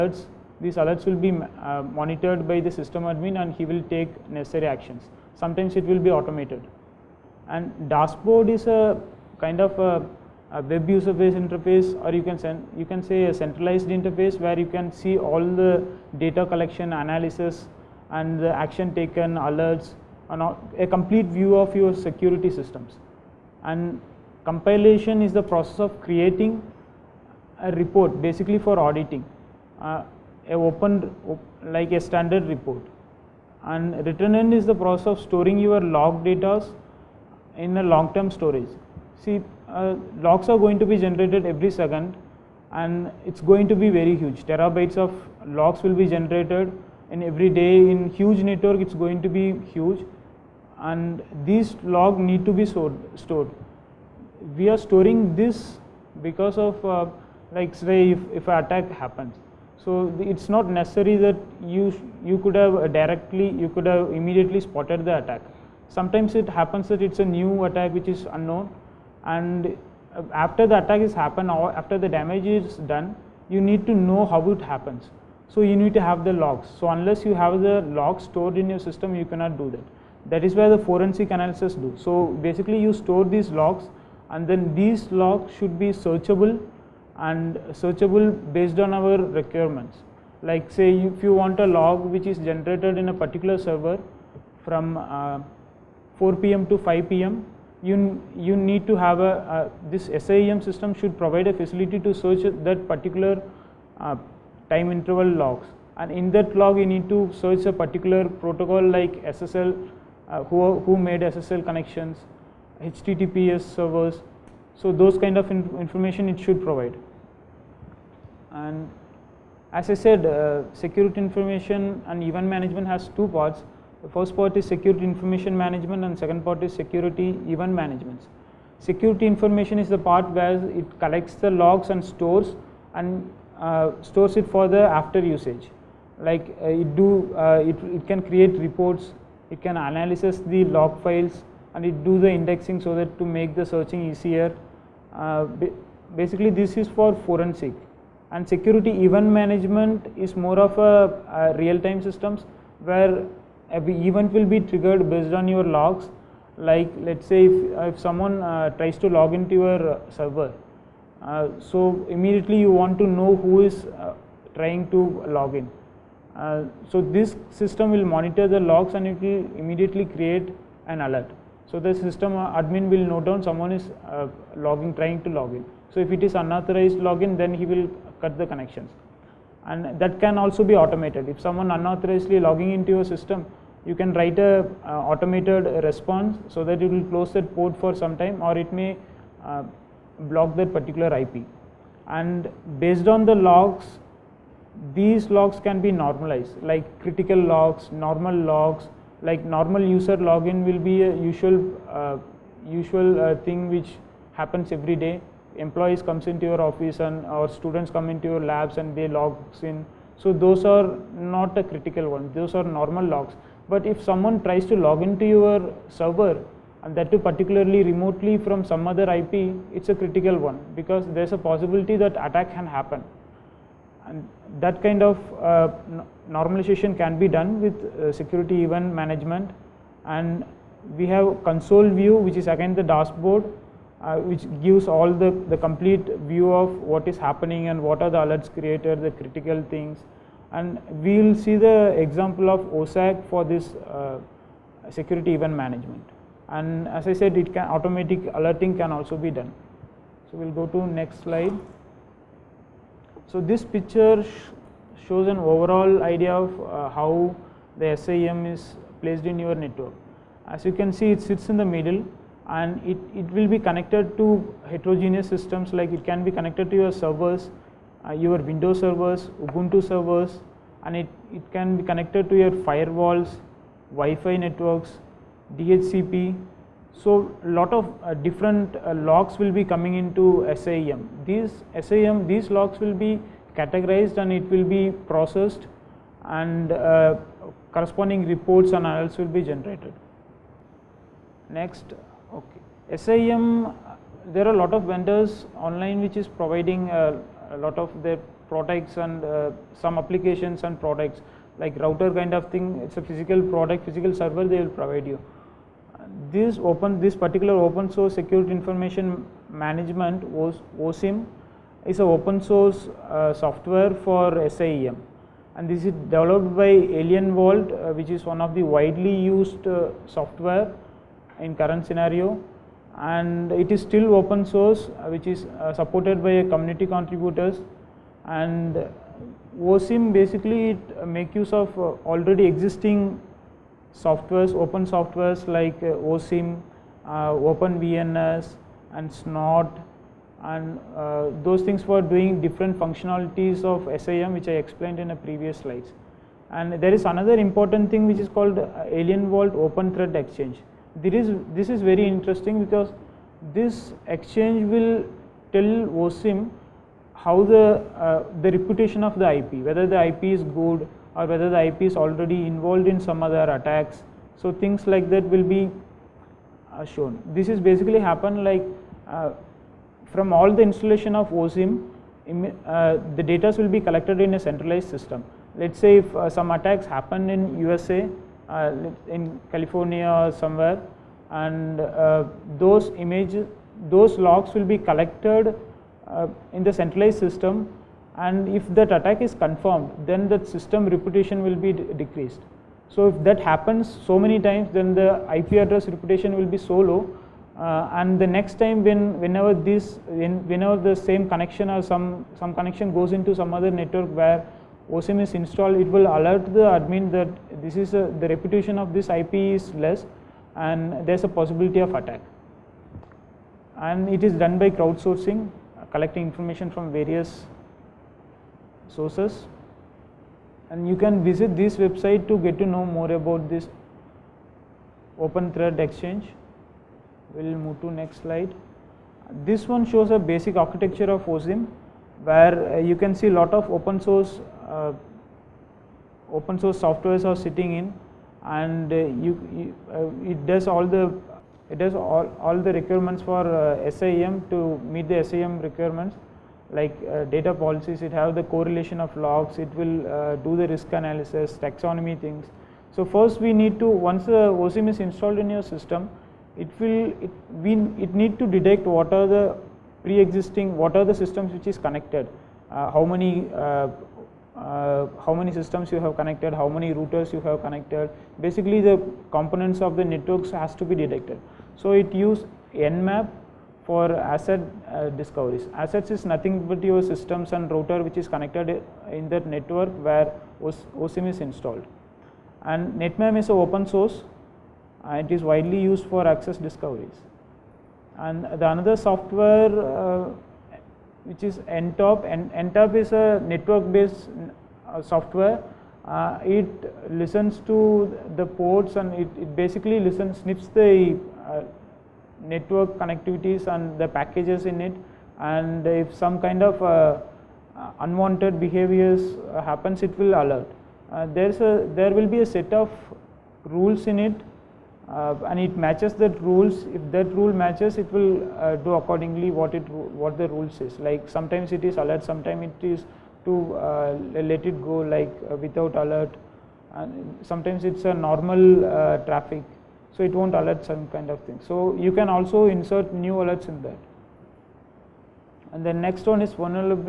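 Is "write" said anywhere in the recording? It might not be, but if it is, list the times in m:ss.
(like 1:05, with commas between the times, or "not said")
3:04.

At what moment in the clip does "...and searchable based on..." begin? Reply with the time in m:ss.
1:27.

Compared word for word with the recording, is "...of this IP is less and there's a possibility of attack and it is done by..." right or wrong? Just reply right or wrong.
right.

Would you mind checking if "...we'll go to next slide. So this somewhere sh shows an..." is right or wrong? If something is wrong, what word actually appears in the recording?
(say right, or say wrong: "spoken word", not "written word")
wrong: "picture", not "somewhere".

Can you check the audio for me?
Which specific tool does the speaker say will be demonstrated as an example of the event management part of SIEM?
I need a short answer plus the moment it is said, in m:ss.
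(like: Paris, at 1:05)
OSSEC, at 4:02.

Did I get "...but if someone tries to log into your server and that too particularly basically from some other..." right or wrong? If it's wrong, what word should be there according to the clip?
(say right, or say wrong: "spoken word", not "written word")
wrong: "remotely", not "basically".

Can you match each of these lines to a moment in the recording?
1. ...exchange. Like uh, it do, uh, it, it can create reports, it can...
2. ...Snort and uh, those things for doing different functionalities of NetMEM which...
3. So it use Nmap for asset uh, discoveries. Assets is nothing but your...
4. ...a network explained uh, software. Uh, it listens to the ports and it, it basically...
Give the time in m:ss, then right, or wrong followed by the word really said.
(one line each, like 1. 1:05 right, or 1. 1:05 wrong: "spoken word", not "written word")
1. 2:15 wrong: "usage", not "exchange"
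2. 5:39 wrong: "SIEM", not "NetMEM"
3. 7:51 right
4. 8:13 wrong: "based", not "explained".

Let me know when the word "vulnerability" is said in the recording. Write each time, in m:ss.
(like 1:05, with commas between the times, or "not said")
8:56.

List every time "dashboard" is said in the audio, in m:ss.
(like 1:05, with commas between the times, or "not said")
0:07, 3:52.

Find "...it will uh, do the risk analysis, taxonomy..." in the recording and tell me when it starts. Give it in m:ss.
7:29.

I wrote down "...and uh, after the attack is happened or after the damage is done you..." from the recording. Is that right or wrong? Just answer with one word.
right.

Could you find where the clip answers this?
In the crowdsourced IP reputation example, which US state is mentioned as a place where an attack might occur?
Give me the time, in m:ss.
6:19.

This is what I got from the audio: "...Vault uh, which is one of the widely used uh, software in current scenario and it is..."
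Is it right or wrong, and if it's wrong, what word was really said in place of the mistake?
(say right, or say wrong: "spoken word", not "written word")
right.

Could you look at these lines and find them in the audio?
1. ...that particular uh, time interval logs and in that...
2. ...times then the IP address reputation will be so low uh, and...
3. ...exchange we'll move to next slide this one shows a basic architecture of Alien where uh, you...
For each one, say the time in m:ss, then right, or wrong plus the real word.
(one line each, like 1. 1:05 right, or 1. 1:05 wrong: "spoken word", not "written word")
1. 1:42 right
2. 6:34 right
3. 7:05 wrong: "OSSIM", not "Alien".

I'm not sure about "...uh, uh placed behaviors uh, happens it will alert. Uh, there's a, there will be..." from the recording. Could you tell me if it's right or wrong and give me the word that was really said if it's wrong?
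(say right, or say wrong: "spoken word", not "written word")
wrong: "unwanted", not "placed".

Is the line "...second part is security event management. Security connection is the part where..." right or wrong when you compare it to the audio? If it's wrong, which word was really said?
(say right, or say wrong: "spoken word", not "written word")
wrong: "information", not "connection".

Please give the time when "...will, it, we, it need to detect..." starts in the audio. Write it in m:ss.
7:36.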